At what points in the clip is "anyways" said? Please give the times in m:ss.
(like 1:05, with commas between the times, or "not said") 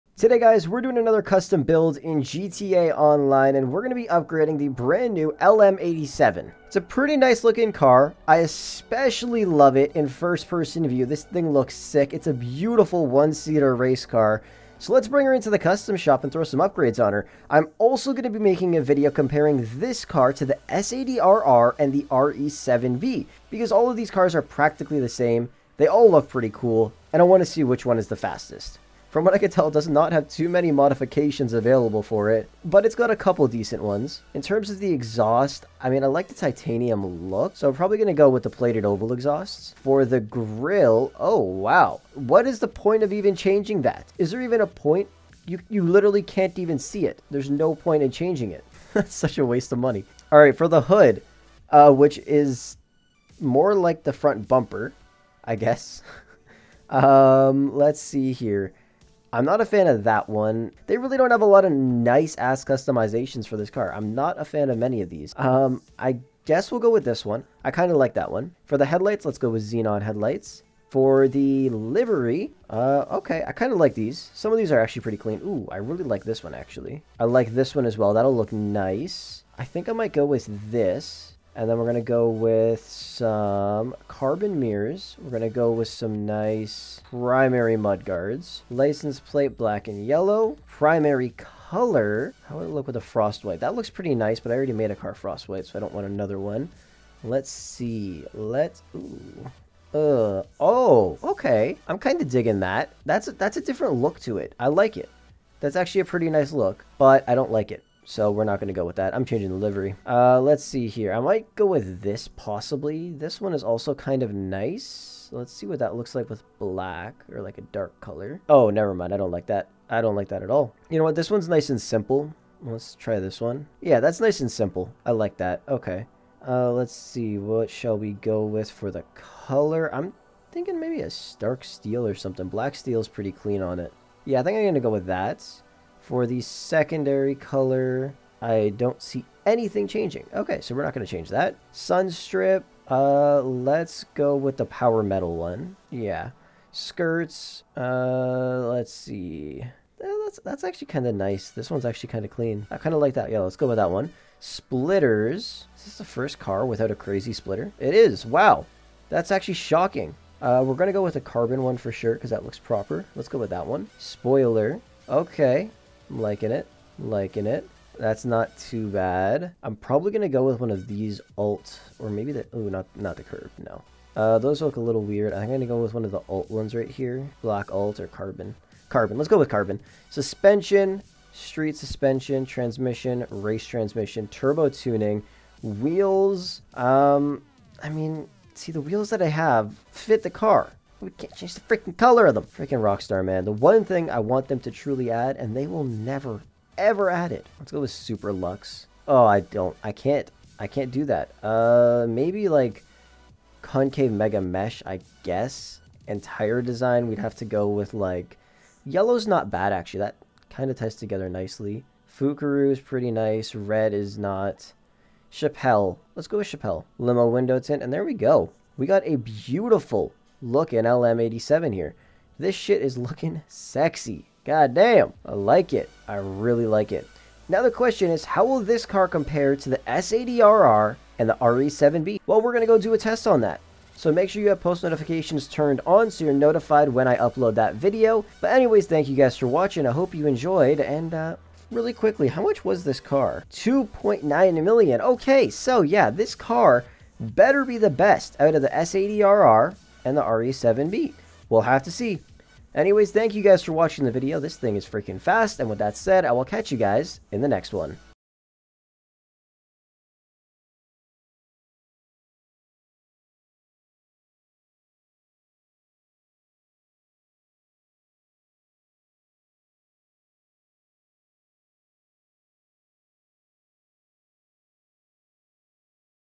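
3:58, 4:12.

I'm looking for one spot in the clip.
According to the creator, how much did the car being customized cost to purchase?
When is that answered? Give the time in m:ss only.
4:03.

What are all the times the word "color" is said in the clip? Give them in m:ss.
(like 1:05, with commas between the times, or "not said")
1:31, 1:58, 2:09, 2:17, 3:11.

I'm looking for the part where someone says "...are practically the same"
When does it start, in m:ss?
0:24.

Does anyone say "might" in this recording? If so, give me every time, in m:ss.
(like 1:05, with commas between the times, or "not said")
1:19, 1:51.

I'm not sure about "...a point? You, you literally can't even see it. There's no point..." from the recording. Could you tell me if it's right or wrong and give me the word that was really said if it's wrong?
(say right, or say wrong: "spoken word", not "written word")
right.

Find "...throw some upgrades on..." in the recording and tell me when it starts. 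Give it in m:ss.
0:16.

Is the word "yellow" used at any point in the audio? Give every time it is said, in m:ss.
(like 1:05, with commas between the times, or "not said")
1:30, 3:28.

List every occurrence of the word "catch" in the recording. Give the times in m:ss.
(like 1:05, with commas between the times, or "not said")
4:16.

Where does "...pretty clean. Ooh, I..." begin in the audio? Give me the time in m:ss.
1:15.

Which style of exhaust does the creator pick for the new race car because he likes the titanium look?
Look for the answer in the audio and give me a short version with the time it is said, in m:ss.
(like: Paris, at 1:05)
Plated oval exhausts, at 0:38.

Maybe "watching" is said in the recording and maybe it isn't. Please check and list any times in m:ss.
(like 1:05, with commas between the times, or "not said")
3:59, 4:13.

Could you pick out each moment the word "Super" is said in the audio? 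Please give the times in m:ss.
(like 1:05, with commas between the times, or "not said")
3:17.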